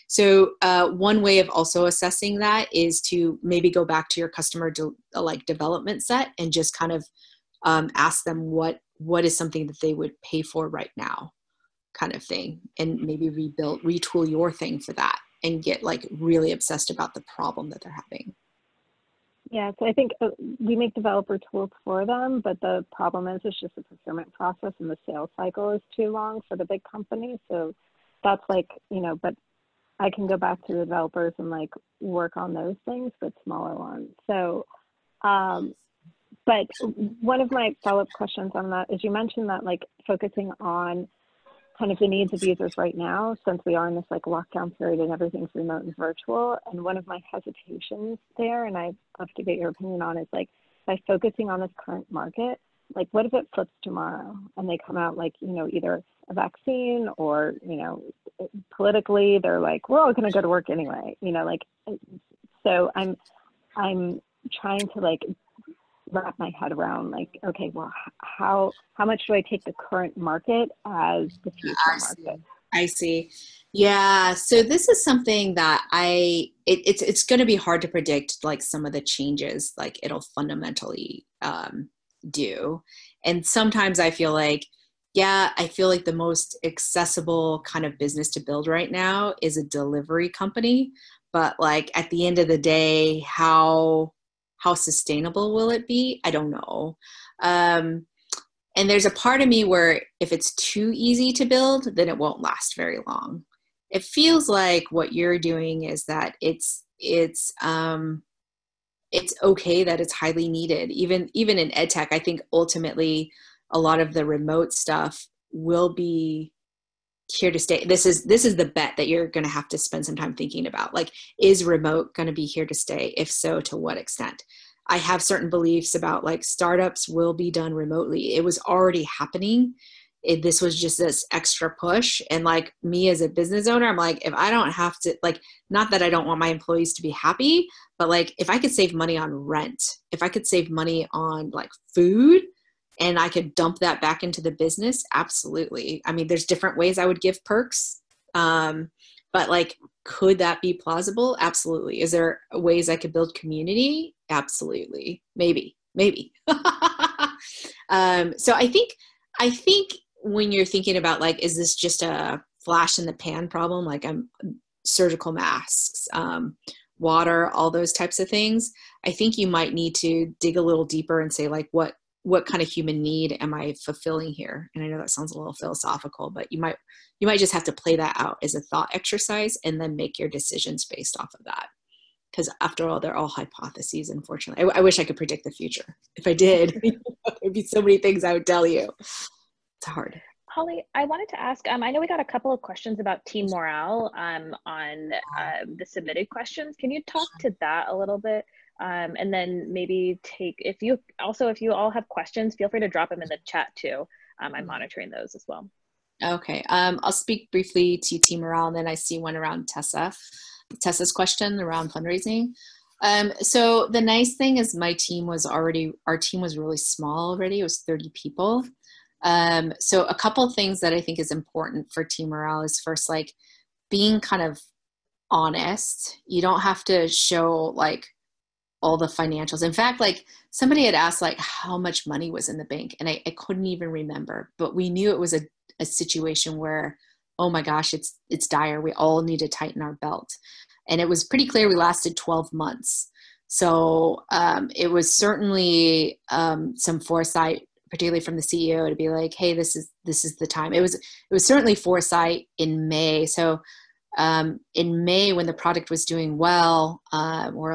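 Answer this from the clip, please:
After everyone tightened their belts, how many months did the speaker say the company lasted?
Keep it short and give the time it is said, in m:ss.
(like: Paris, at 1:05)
12 months, at 4:02.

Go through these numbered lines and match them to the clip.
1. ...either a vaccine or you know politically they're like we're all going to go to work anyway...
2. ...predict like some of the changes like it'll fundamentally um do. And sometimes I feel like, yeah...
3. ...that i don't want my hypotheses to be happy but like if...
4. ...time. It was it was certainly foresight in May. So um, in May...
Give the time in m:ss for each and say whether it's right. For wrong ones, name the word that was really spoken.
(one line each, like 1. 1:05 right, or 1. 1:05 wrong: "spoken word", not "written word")
1. 0:55 right
2. 1:17 right
3. 2:15 wrong: "employees", not "hypotheses"
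4. 4:10 right.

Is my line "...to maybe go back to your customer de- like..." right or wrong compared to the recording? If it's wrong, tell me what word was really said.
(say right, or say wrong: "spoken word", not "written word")
right.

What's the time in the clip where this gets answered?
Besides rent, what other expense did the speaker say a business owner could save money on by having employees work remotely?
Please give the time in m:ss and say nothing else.
2:21.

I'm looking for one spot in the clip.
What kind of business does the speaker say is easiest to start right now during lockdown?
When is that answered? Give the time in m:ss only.
1:29.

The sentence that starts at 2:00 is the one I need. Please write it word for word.
Like, is remote going to be here to stay?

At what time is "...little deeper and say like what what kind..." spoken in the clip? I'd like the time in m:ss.
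2:50.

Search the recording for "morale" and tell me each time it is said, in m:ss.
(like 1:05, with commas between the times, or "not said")
3:13, 3:28, 3:42.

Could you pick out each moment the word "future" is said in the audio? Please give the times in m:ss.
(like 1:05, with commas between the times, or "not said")
1:11, 3:05.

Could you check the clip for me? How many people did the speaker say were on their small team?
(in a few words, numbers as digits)
30.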